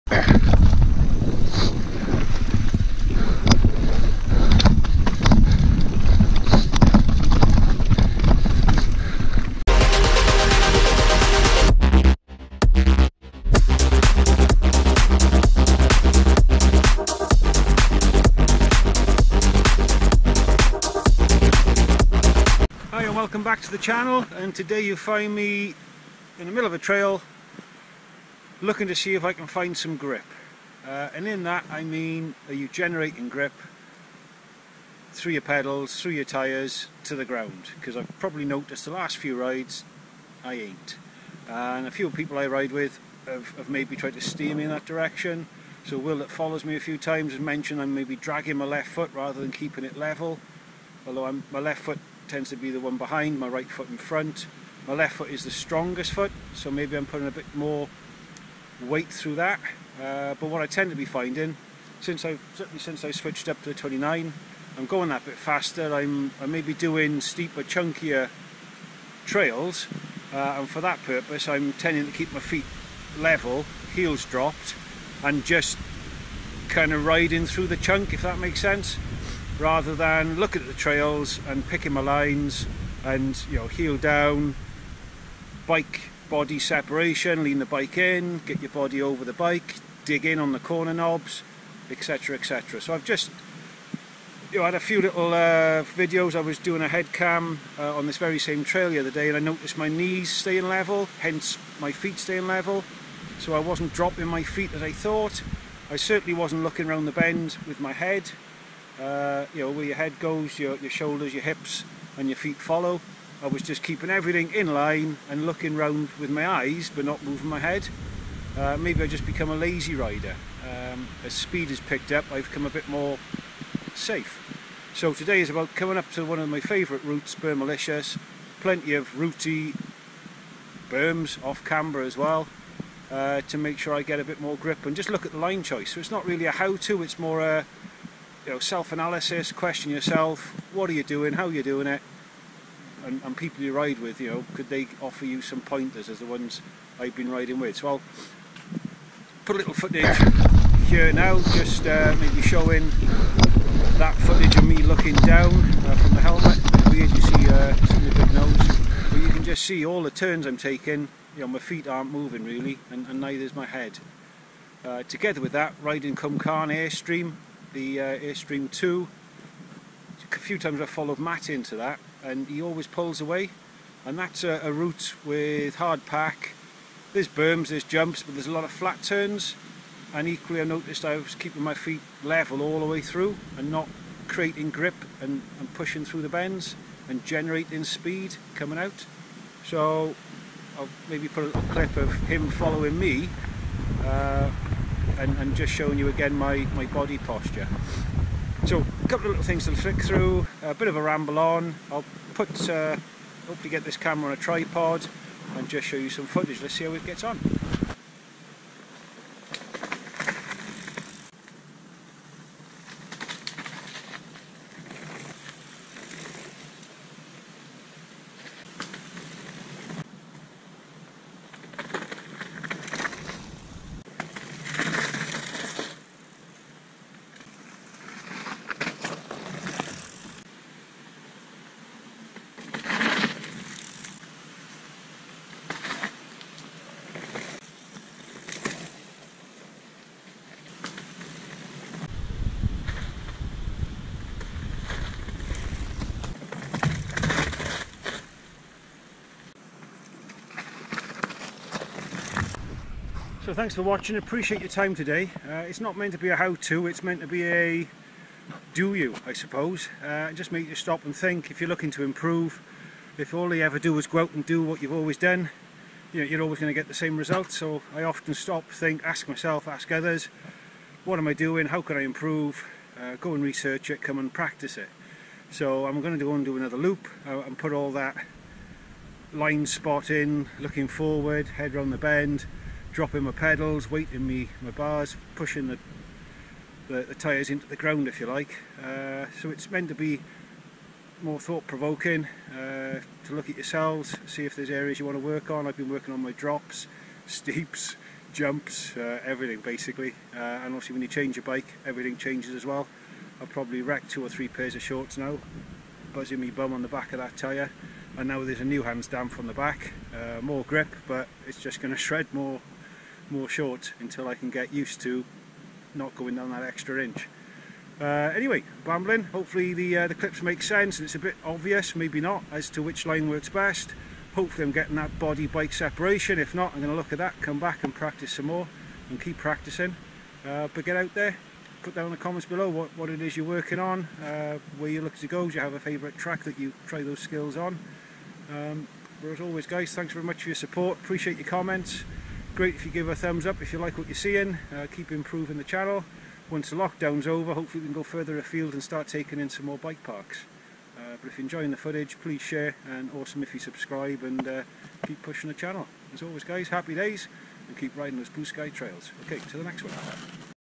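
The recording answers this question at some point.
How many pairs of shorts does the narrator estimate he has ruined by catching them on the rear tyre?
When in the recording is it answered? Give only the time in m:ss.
5:04.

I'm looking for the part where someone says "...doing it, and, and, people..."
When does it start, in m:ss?
2:21.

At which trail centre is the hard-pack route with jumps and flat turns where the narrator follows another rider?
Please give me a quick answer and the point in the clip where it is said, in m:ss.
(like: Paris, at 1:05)
Cwmcarn, at 2:46.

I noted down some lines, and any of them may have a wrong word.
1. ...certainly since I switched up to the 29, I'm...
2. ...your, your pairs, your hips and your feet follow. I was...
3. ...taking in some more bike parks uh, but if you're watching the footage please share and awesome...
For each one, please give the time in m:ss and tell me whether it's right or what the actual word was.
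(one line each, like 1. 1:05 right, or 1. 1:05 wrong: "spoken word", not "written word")
1. 1:02 right
2. 1:50 wrong: "shoulders", not "pairs"
3. 5:49 wrong: "enjoying", not "watching".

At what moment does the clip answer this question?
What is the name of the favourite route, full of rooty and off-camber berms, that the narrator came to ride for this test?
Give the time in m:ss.
2:07.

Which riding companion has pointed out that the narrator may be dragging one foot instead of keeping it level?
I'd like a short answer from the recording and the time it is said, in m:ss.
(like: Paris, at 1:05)
Will, at 0:45.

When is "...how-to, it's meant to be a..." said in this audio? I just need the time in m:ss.
4:16.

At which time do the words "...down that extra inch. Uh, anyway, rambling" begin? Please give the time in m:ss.
5:16.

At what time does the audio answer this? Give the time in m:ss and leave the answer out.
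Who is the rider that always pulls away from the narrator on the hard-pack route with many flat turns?
2:51.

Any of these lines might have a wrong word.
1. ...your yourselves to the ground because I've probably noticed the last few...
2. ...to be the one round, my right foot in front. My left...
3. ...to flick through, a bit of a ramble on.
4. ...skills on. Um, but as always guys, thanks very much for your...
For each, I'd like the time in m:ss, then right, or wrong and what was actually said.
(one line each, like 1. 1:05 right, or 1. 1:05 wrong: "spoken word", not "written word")
1. 0:36 wrong: "tyres", not "yourselves"
2. 0:52 wrong: "behind", not "round"
3. 3:19 right
4. 5:37 right.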